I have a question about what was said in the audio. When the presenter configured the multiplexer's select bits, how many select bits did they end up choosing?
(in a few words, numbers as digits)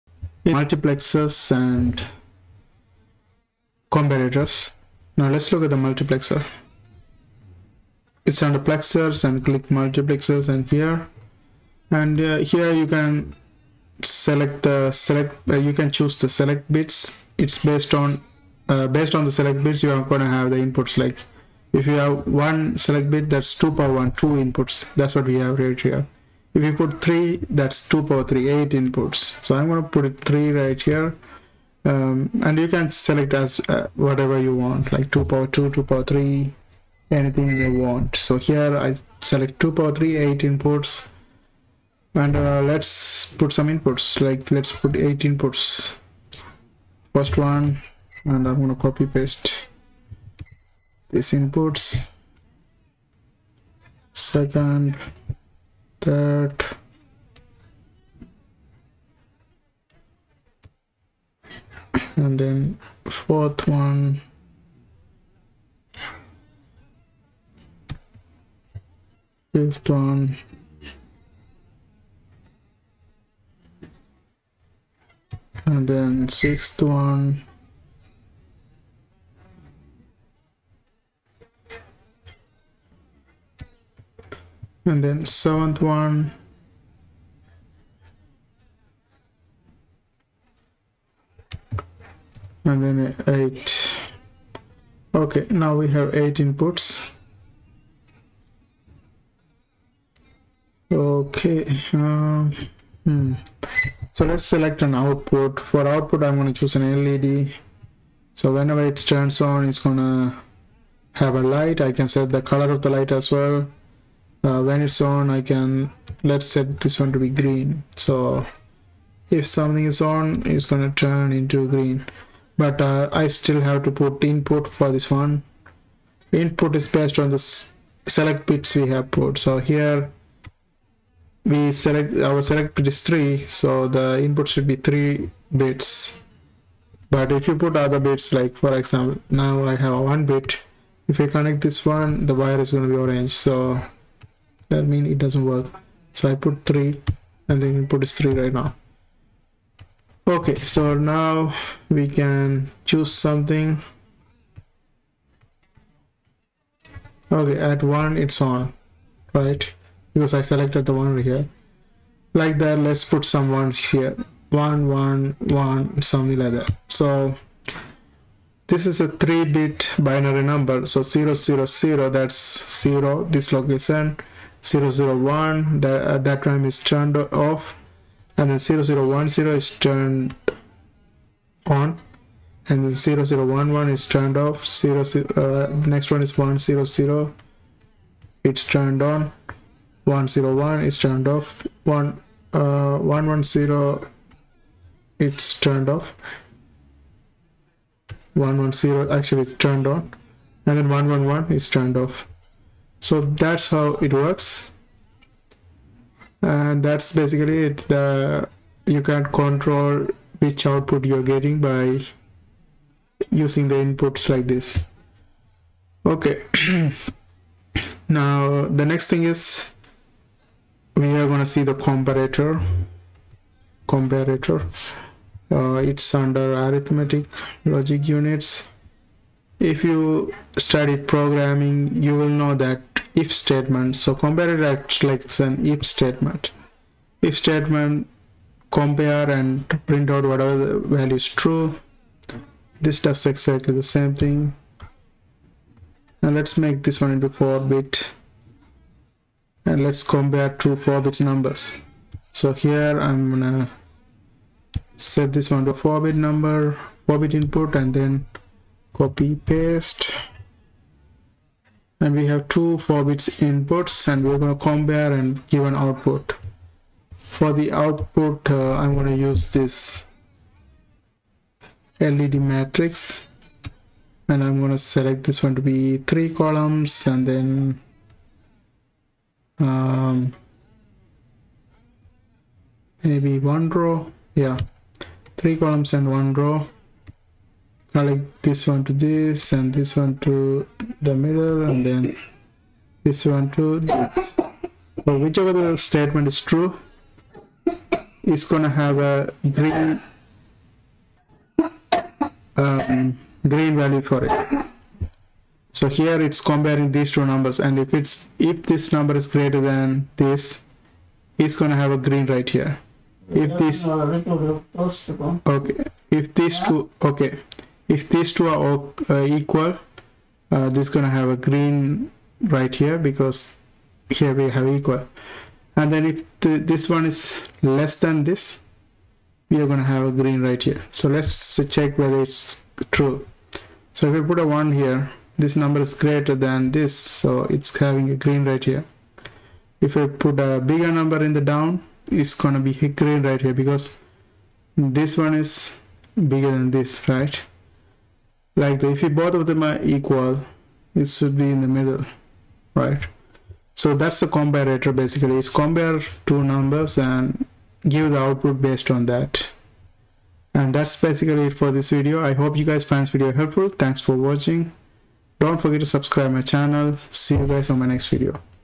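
3.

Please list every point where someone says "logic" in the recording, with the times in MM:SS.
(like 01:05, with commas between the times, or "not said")
03:47.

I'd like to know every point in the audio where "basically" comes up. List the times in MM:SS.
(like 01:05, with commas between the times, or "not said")
03:27, 05:54, 06:01.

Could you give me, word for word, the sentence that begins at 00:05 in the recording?
Now let's look at the multiplexer.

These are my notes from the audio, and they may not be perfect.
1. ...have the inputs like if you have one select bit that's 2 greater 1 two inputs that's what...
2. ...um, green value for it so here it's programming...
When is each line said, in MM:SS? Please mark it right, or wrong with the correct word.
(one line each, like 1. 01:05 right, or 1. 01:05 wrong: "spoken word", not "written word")
1. 00:20 wrong: "power", not "greater"
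2. 05:02 wrong: "comparing", not "programming".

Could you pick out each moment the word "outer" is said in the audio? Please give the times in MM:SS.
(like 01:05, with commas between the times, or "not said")
not said.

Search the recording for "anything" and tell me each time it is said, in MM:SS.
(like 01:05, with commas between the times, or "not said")
00:37.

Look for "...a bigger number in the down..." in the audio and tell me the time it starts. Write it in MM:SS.
05:40.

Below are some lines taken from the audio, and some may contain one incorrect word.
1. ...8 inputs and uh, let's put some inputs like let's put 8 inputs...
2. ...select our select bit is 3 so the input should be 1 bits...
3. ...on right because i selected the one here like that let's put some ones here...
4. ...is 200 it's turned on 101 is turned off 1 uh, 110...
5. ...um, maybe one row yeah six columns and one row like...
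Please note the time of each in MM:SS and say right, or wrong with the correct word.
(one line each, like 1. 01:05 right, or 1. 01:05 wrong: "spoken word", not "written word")
1. 00:40 right
2. 02:11 wrong: "3", not "1"
3. 02:38 right
4. 03:06 wrong: "100", not "200"
5. 04:39 wrong: "three", not "six".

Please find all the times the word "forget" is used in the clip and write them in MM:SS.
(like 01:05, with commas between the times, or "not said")
06:05.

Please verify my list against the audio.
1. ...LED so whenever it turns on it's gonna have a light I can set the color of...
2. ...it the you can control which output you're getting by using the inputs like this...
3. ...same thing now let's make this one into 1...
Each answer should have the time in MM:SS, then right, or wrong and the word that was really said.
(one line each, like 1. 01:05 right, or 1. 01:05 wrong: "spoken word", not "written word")
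1. 01:47 right
2. 03:27 right
3. 04:03 wrong: "4", not "1".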